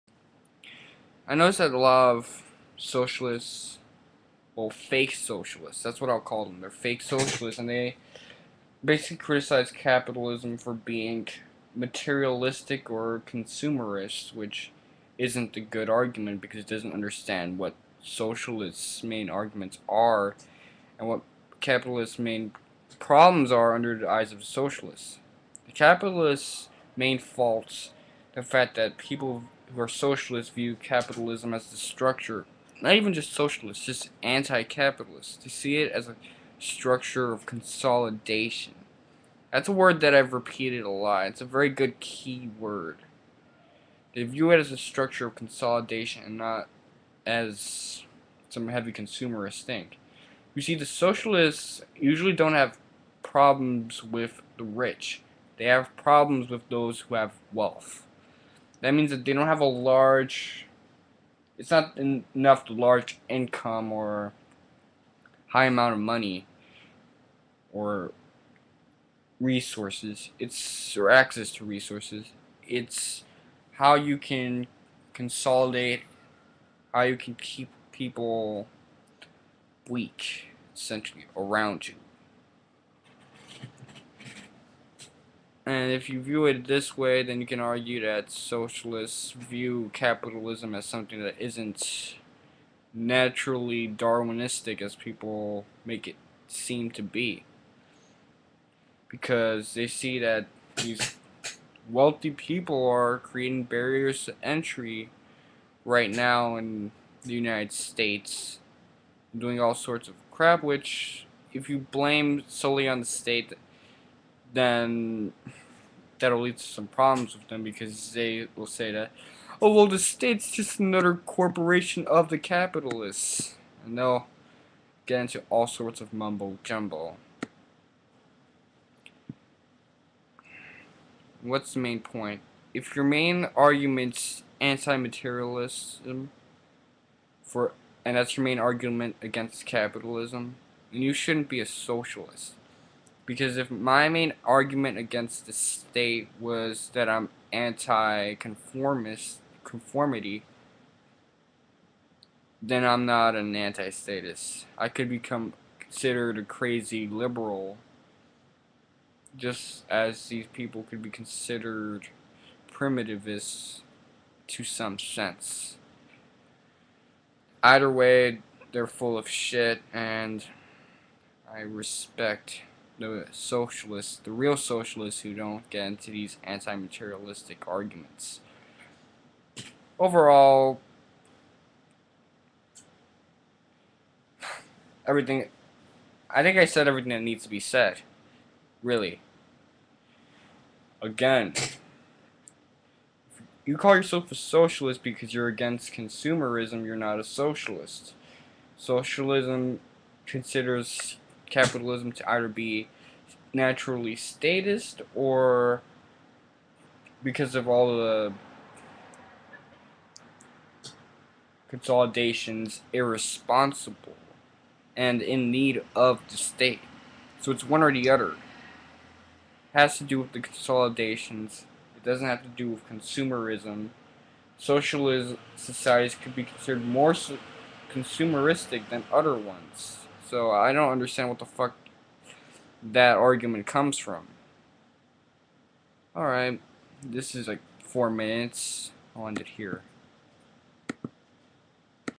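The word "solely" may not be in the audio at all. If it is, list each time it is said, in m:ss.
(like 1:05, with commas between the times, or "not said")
1:52.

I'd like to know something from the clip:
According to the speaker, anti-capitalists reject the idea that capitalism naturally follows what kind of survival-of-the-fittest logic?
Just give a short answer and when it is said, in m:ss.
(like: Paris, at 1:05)
Darwinistic, at 1:33.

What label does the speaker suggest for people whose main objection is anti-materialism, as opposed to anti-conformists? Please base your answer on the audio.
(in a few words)
primitivists.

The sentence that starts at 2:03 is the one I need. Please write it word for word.
And they'll get into all sorts of mumbo jumbo.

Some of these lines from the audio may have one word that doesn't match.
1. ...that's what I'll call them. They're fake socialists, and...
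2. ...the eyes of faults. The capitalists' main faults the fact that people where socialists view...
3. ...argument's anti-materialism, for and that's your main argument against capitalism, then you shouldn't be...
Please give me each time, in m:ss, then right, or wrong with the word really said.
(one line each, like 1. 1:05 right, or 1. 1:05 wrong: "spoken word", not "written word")
1. 0:05 right
2. 0:23 wrong: "socialists", not "faults"
3. 2:13 right.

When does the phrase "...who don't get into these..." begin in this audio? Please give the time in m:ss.
2:55.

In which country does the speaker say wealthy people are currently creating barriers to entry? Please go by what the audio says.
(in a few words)
United States.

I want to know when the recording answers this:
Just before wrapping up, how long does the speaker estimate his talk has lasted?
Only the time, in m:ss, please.
3:57.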